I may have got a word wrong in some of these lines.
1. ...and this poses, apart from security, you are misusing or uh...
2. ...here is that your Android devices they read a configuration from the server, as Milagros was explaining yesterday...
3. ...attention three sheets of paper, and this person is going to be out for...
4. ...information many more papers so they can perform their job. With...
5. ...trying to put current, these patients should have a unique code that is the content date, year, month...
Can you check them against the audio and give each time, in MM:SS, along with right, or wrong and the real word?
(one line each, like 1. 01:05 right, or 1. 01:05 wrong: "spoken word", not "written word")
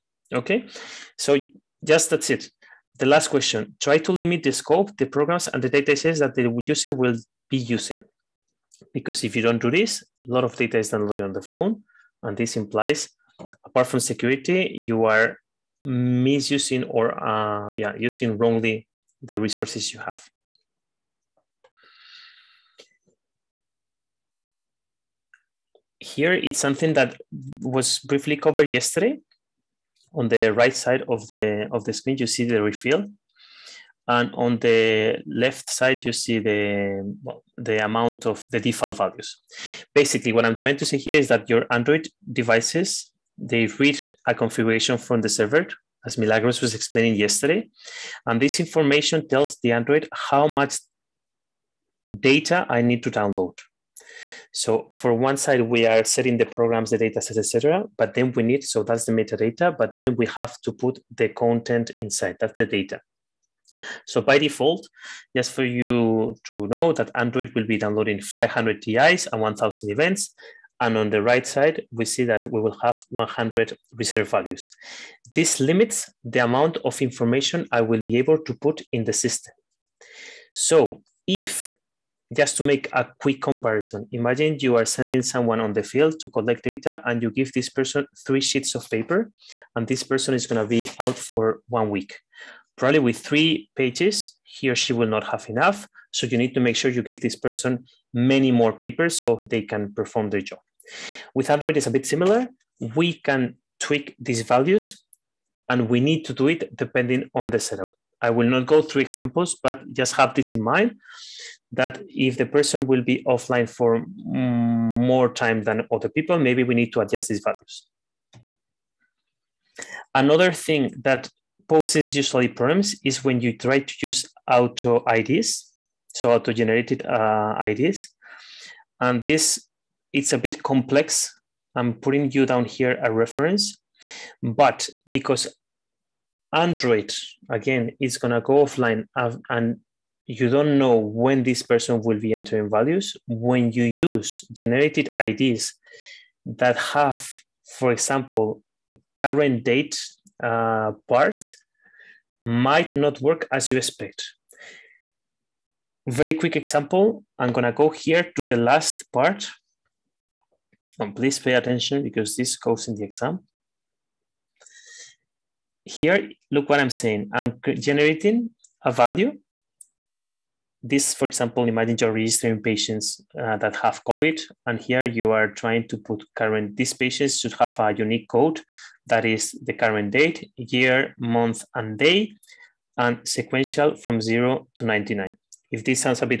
1. 00:12 wrong: "implies", not "poses"
2. 00:40 right
3. 01:27 wrong: "person", not "attention"
4. 01:37 wrong: "person", not "information"
5. 02:55 wrong: "current", not "content".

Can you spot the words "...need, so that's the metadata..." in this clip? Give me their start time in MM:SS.
00:58.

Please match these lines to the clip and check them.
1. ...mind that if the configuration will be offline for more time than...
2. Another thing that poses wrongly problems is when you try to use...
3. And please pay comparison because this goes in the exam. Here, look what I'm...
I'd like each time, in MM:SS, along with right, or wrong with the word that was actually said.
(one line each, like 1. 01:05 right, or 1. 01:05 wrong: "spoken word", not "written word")
1. 01:50 wrong: "person", not "configuration"
2. 02:00 wrong: "usually", not "wrongly"
3. 02:40 wrong: "attention", not "comparison".